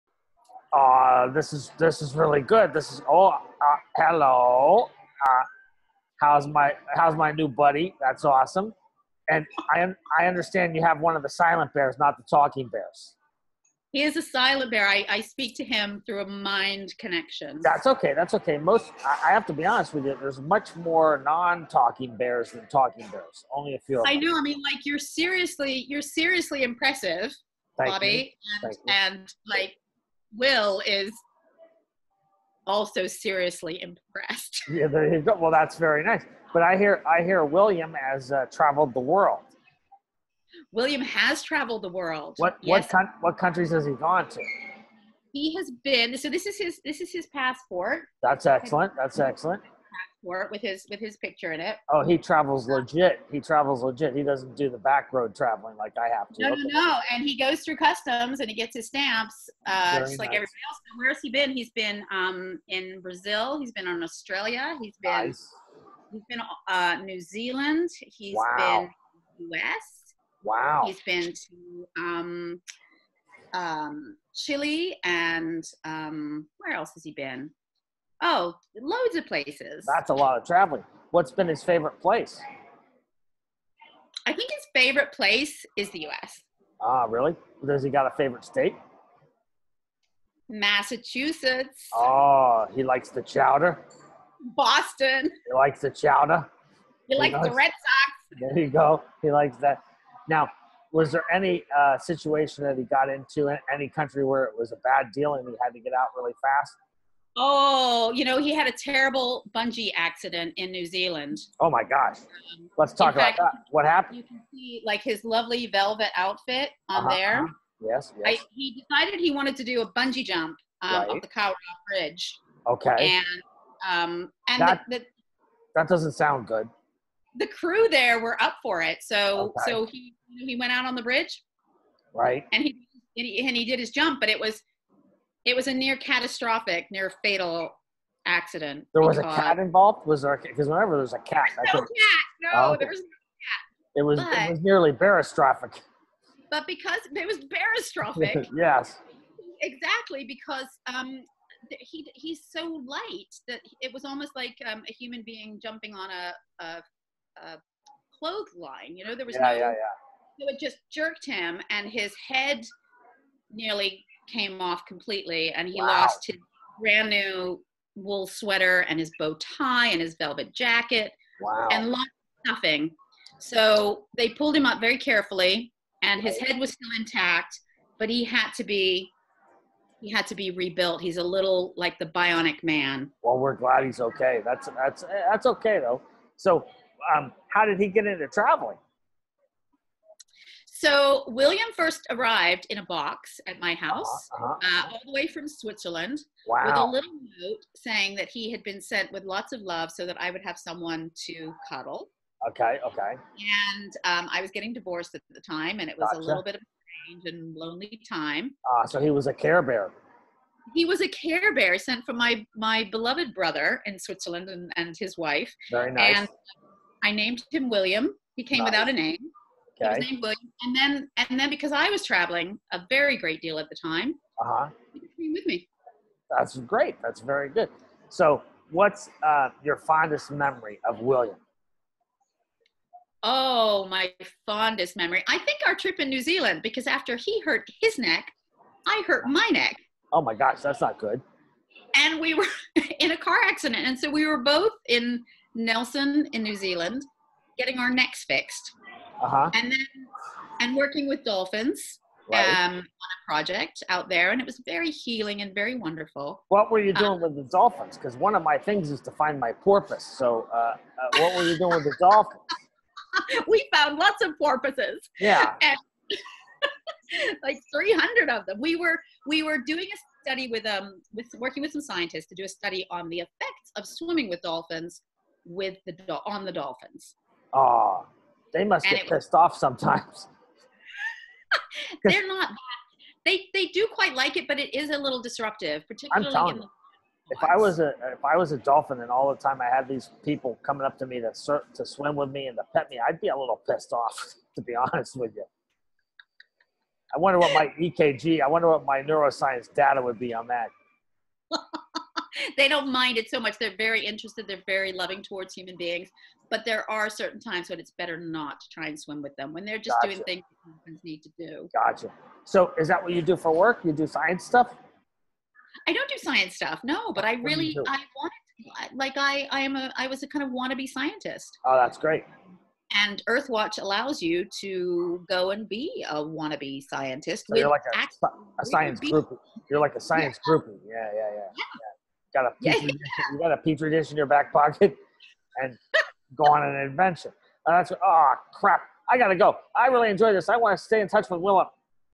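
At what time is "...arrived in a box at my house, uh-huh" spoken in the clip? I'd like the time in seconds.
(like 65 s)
192 s.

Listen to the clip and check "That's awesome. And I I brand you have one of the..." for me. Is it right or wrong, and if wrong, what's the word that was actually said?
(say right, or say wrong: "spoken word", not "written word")
wrong: "understand", not "brand".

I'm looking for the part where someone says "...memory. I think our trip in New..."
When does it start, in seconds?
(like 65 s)
234 s.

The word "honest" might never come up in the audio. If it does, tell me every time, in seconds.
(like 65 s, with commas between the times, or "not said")
19 s, 294 s.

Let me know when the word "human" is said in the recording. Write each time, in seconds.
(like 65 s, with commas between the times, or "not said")
154 s, 305 s, 310 s.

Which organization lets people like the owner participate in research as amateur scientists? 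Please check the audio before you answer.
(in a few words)
Earthwatch.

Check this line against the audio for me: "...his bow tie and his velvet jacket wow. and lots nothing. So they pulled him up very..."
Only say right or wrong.
right.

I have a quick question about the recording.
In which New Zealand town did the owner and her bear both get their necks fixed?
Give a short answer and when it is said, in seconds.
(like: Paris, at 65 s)
Nelson, at 245 s.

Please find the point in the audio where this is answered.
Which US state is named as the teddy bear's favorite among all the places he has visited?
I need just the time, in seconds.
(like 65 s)
90 s.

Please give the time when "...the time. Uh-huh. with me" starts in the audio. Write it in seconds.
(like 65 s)
223 s.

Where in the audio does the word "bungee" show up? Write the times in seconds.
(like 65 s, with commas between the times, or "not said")
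109 s, 119 s.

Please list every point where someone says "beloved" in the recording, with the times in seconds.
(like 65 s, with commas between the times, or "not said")
212 s.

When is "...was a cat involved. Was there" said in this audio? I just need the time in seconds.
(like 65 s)
139 s.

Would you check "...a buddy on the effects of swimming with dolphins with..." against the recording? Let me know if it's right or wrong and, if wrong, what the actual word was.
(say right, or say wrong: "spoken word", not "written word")
wrong: "study", not "buddy".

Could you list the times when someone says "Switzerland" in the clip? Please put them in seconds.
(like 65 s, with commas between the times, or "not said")
195 s, 213 s.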